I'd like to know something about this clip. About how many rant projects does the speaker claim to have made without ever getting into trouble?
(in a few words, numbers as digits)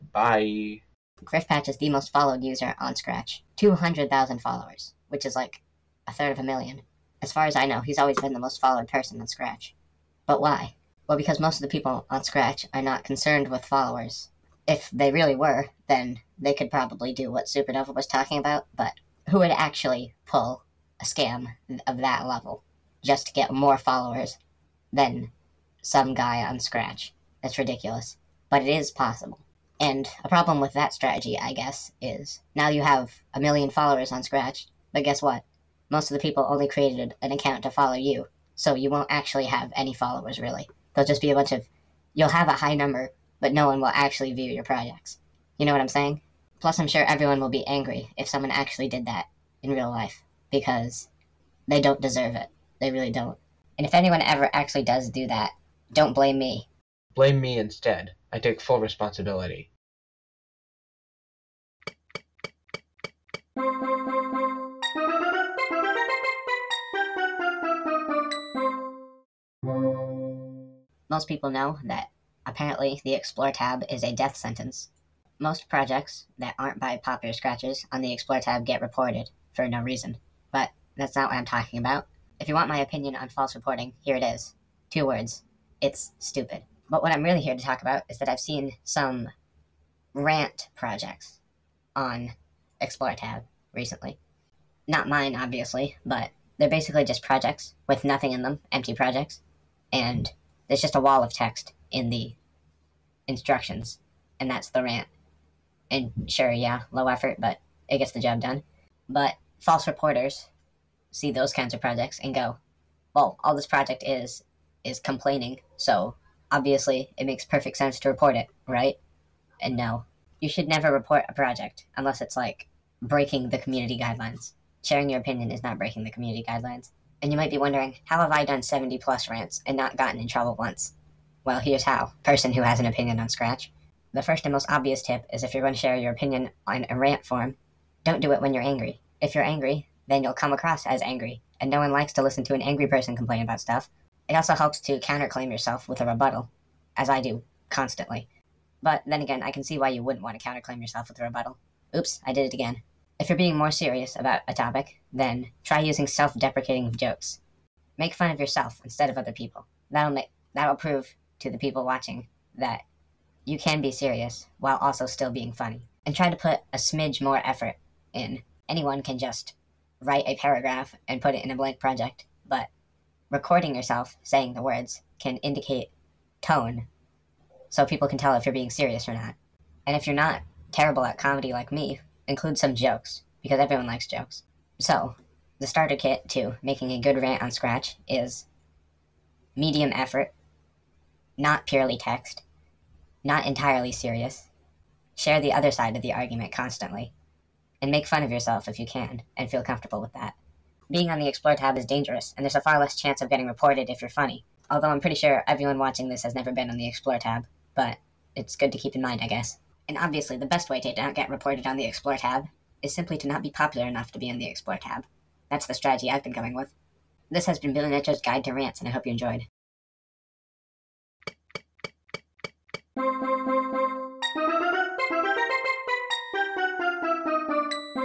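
70 plus.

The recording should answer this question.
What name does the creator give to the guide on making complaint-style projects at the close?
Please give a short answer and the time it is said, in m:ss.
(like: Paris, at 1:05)
Billy Nut Joe's Guide to Rants, at 3:37.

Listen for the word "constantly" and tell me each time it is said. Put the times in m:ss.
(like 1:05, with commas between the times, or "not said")
2:27, 3:16.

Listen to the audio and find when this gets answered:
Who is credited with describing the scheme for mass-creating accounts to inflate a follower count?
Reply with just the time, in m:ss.
0:17.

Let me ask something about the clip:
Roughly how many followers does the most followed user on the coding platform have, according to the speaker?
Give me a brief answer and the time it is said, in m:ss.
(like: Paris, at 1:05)
200,000, at 0:03.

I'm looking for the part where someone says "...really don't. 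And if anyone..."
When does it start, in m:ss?
0:52.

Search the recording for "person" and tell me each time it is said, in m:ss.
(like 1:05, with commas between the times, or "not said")
0:08, 2:12, 2:22.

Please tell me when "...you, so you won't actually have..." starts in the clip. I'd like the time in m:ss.
0:37.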